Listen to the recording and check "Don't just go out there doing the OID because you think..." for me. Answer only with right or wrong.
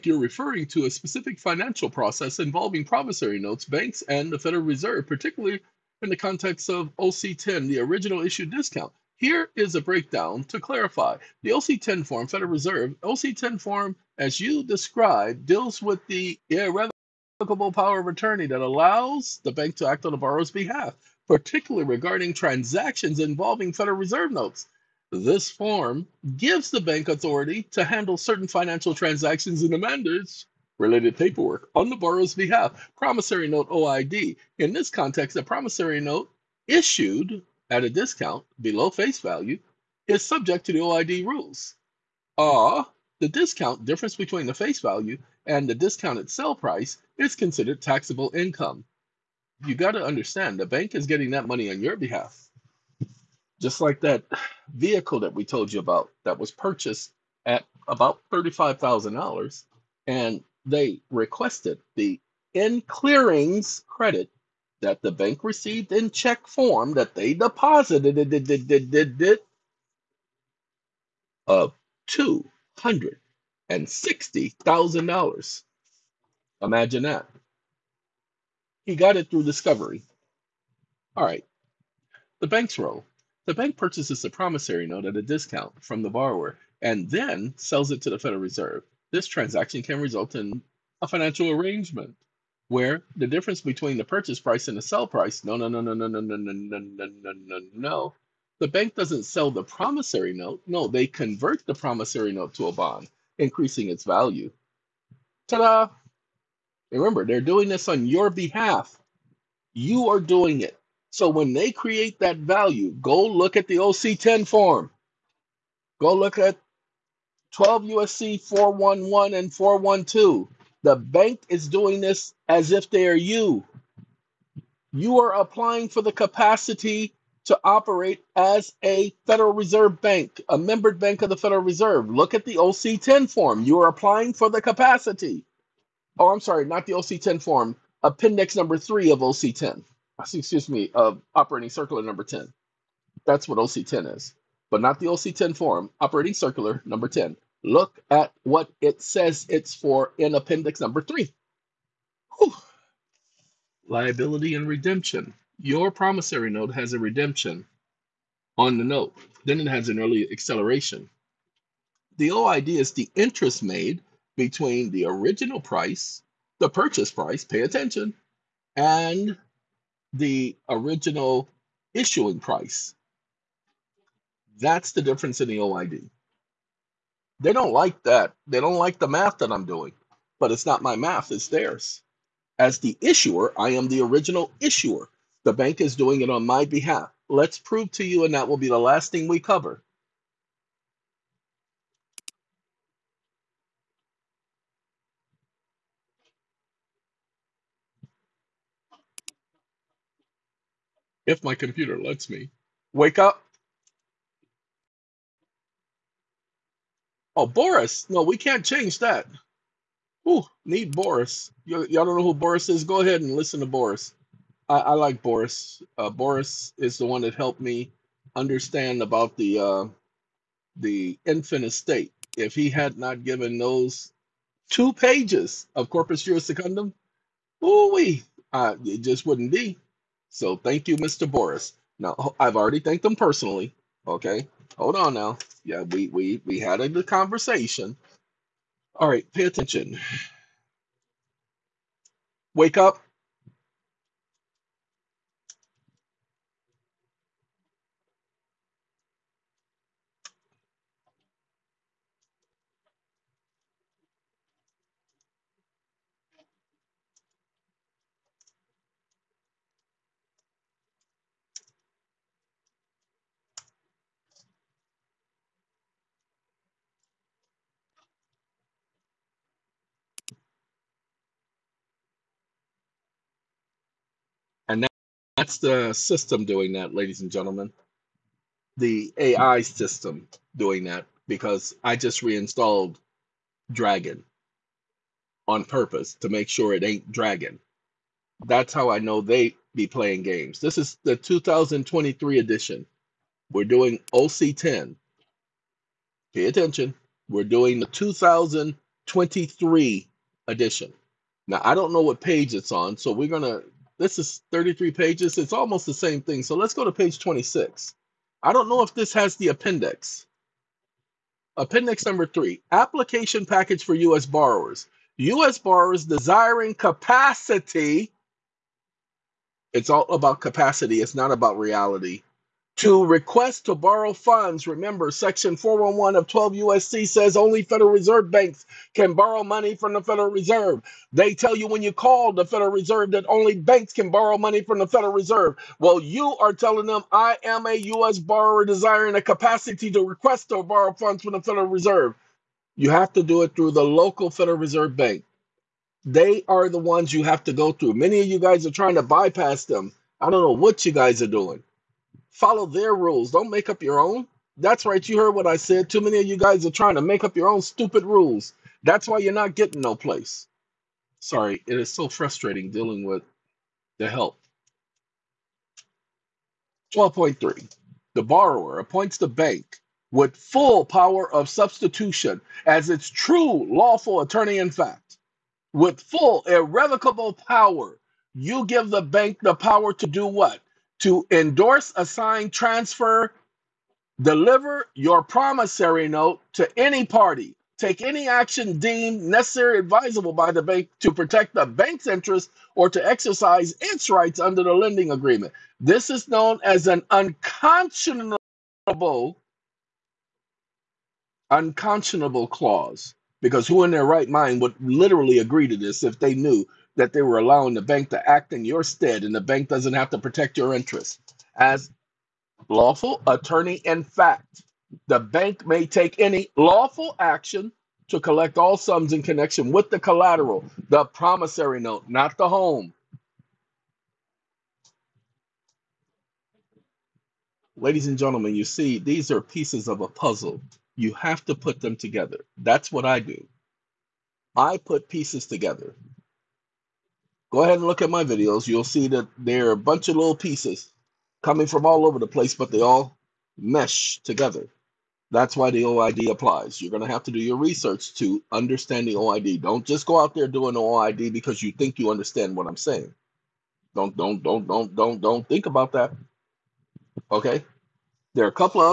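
right.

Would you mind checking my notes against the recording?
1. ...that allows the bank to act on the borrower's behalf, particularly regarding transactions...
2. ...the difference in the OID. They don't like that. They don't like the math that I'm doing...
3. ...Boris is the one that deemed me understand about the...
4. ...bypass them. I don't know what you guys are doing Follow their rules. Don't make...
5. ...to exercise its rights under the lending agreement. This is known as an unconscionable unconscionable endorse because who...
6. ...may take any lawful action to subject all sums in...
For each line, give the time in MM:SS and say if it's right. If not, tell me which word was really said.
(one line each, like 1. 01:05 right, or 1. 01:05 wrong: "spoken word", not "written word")
1. 00:18 right
2. 02:54 right
3. 03:36 wrong: "helped", not "deemed"
4. 05:49 right
5. 06:32 wrong: "clause", not "endorse"
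6. 06:55 wrong: "collect", not "subject".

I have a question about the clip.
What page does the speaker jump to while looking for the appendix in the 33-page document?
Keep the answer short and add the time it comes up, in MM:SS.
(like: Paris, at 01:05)
26, at 05:06.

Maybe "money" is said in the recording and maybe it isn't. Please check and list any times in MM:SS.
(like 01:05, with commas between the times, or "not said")
00:51, 05:29, 05:34.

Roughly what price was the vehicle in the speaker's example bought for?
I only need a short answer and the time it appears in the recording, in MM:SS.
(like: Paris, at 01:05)
$35,000, at 00:58.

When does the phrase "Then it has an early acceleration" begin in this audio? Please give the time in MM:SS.
02:39.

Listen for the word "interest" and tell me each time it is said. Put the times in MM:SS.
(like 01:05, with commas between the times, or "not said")
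02:43, 06:32, 06:50.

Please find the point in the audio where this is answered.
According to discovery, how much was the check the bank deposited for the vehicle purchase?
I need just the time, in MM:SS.
01:12.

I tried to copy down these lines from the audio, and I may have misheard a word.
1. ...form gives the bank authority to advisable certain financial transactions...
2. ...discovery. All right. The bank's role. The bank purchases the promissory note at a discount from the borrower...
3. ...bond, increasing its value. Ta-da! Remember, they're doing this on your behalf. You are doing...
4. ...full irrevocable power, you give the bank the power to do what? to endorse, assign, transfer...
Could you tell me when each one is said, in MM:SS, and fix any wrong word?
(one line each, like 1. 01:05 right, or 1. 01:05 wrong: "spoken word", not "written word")
1. 00:25 wrong: "handle", not "advisable"
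2. 01:19 right
3. 01:42 right
4. 06:16 right.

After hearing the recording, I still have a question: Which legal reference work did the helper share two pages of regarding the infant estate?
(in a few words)
Corpus Juris Secundum.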